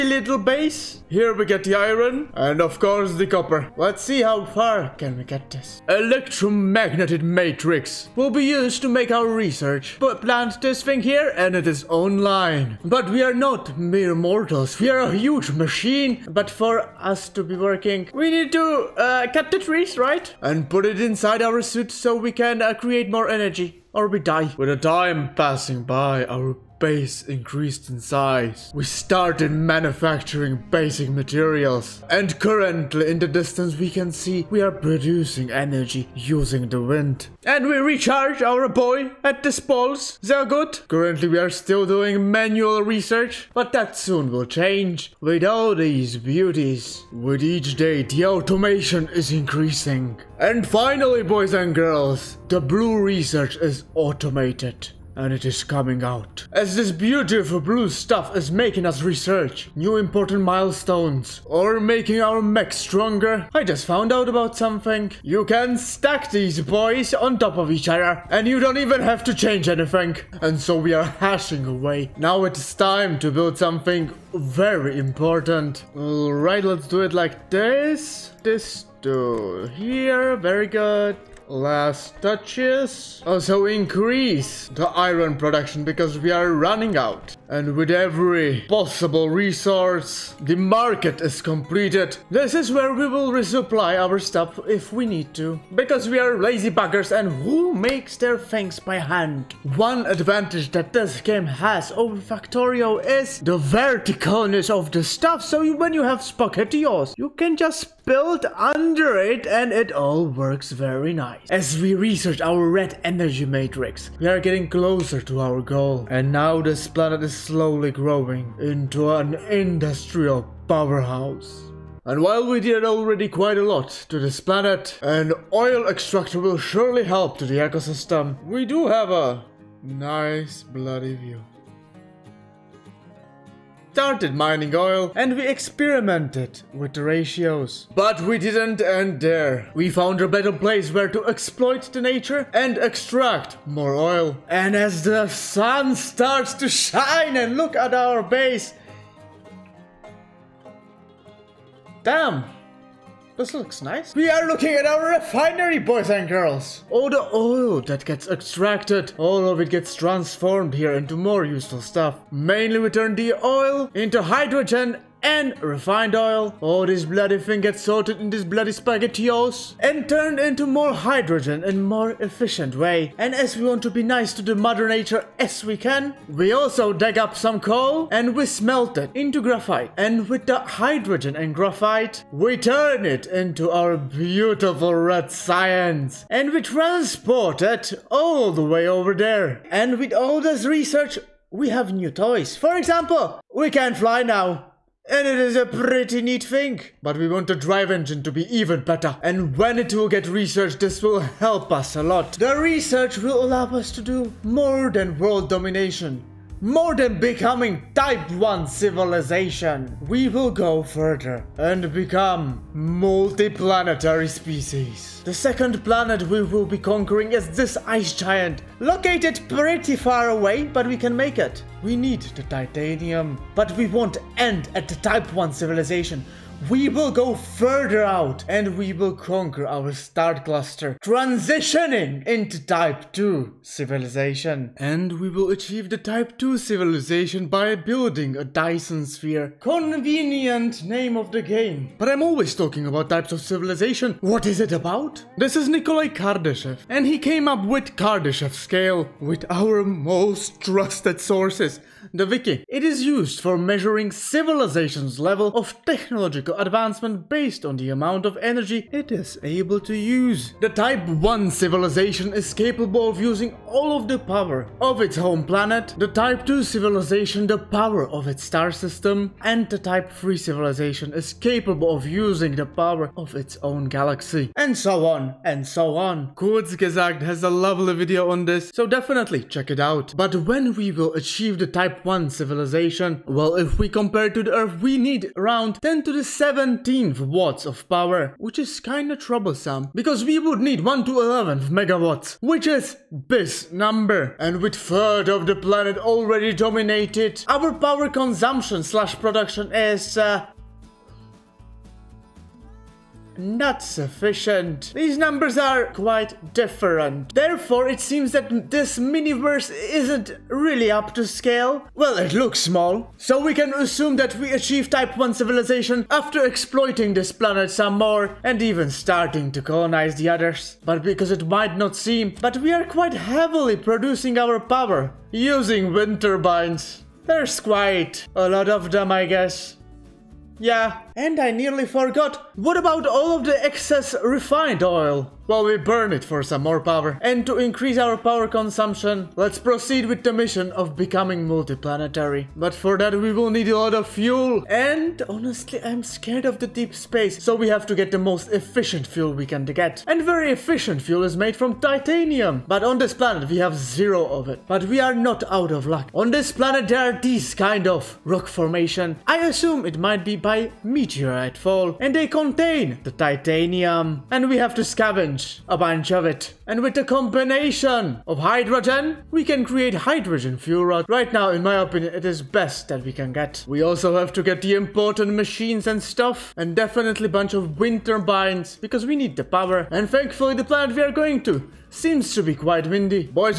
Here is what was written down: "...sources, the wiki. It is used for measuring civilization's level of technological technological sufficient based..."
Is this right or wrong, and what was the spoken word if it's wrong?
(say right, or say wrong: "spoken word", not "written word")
wrong: "advancement", not "sufficient".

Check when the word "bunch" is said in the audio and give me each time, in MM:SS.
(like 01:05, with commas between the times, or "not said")
06:05, 06:17.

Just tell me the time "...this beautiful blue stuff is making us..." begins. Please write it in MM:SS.
00:56.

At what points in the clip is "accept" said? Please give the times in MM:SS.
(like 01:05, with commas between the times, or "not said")
not said.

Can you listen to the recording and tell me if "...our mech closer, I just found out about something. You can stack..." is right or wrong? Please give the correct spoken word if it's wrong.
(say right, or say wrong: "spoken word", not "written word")
wrong: "stronger", not "closer".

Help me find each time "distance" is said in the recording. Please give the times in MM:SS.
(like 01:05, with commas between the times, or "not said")
00:33.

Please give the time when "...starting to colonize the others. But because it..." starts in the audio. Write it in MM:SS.
05:18.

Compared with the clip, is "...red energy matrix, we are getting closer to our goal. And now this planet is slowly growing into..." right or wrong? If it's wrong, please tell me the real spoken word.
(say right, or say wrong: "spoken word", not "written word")
right.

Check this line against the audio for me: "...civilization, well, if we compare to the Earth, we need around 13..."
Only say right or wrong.
wrong.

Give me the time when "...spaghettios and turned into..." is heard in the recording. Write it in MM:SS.
02:48.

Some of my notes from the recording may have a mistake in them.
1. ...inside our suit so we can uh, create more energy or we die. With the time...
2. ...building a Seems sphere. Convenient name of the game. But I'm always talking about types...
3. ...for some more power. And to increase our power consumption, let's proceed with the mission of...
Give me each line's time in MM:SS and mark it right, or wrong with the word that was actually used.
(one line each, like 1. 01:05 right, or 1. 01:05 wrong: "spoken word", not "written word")
1. 00:20 right
2. 03:57 wrong: "Dyson", not "Seems"
3. 05:36 right.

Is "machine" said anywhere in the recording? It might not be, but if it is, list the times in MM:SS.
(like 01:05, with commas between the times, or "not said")
00:15, 06:15.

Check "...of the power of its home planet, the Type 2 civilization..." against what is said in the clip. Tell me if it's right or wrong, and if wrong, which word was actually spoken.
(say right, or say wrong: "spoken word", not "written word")
right.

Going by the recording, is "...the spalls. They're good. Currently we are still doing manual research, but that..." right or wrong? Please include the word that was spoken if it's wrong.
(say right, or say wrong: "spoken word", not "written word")
right.